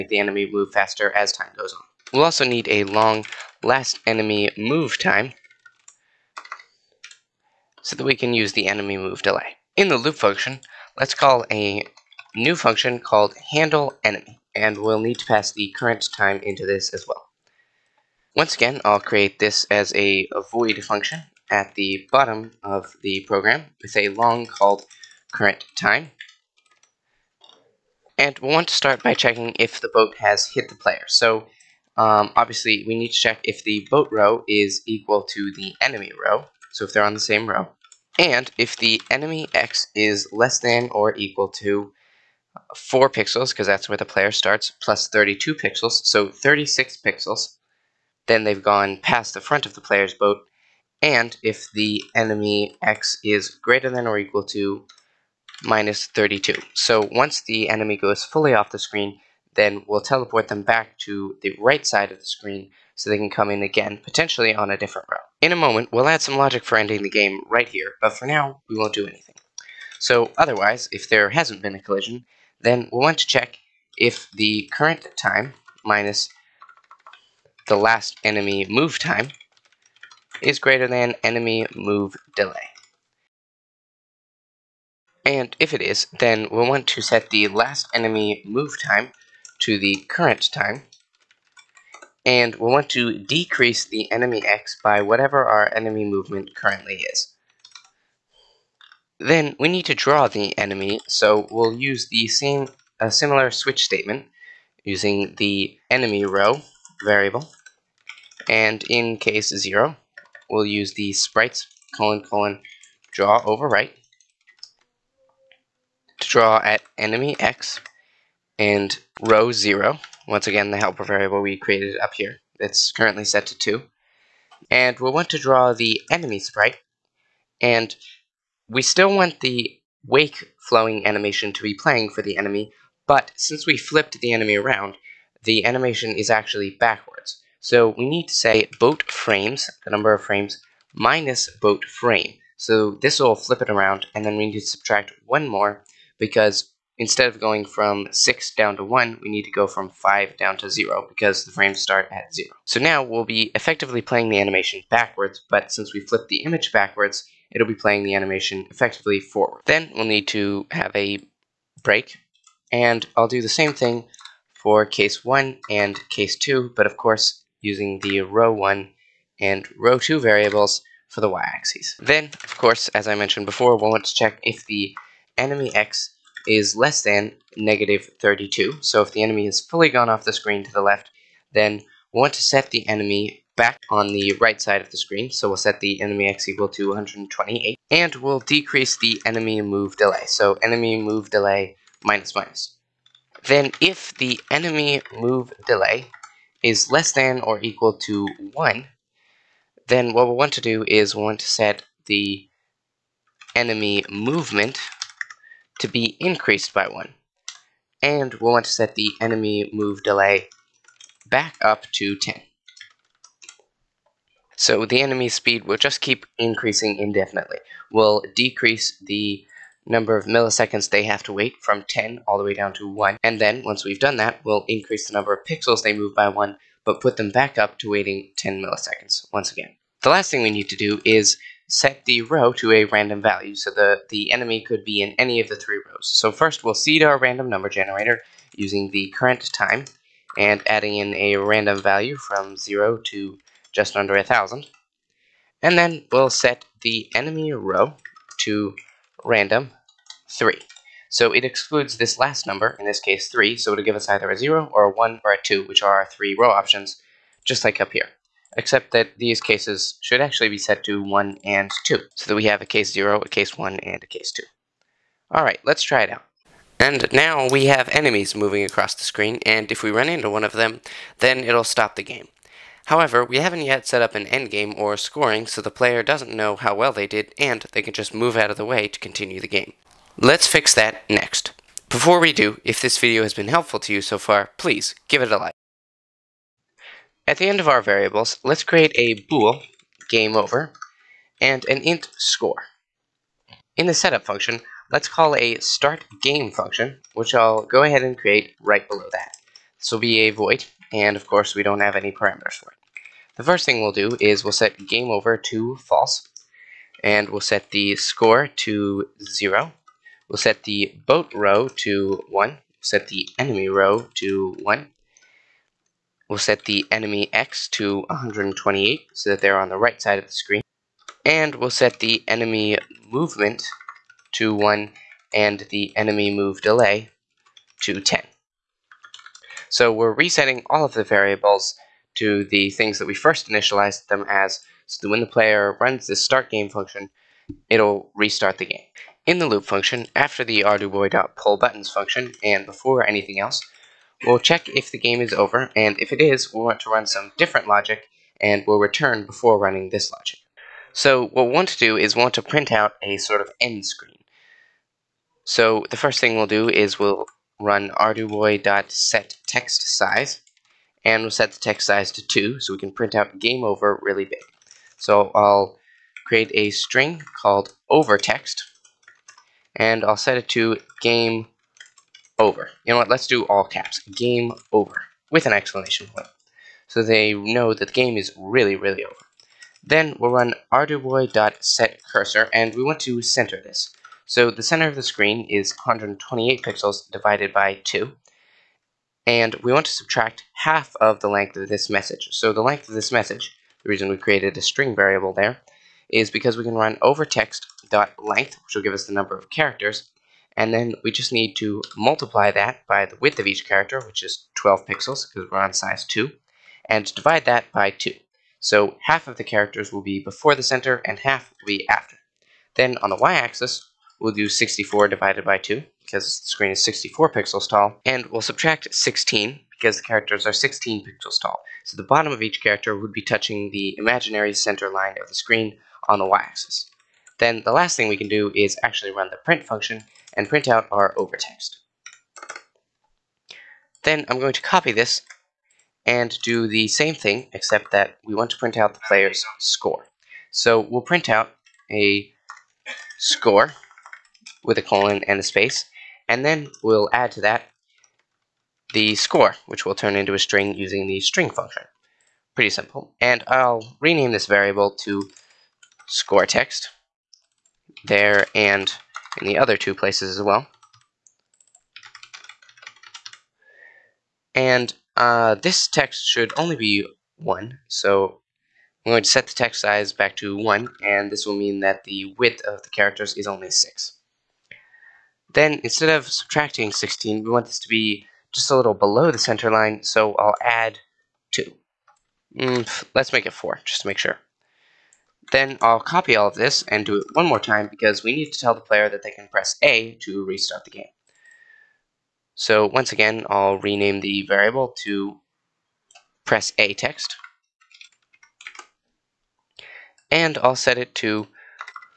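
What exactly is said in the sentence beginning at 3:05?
So we'll set the enemy x equal to 128.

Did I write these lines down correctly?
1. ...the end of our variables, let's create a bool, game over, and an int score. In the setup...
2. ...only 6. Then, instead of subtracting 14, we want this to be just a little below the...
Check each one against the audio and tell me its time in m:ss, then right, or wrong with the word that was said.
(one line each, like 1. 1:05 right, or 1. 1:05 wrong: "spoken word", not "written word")
1. 4:47 right
2. 7:53 wrong: "16", not "14".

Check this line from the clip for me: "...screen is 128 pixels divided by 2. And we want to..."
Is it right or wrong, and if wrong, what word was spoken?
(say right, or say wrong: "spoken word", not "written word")
right.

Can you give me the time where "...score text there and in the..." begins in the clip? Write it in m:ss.
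7:36.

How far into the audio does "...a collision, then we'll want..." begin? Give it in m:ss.
1:11.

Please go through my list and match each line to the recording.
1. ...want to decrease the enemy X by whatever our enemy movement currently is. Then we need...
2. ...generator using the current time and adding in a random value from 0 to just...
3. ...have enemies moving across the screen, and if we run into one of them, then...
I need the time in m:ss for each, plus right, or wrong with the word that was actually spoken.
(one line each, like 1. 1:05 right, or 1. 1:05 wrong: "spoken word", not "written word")
1. 1:32 right
2. 3:57 right
3. 4:27 right.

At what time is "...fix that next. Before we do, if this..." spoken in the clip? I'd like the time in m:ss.
4:40.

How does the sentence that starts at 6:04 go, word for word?
So I'll create a string called overText, and I'll set it to game over.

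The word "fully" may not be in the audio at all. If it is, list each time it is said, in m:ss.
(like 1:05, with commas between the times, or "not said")
0:58, 2:59.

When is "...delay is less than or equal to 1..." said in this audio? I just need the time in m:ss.
3:15.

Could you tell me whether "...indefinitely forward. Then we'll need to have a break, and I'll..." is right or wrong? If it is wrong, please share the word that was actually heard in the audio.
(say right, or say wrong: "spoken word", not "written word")
wrong: "effectively", not "indefinitely".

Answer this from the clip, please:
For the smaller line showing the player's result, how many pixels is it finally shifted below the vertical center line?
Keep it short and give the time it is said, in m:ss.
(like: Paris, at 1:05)
4, at 8:03.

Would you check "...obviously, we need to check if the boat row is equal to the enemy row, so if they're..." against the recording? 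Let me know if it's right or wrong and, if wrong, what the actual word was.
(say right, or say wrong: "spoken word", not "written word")
right.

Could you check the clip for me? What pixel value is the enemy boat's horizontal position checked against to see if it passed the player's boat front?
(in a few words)
36 pixels.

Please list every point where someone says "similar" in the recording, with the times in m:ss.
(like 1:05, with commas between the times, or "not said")
1:43.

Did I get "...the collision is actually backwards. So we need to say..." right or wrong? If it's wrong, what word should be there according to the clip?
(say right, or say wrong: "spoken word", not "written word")
wrong: "animation", not "collision".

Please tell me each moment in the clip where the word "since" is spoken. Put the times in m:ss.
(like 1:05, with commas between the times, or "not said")
2:13, 2:35.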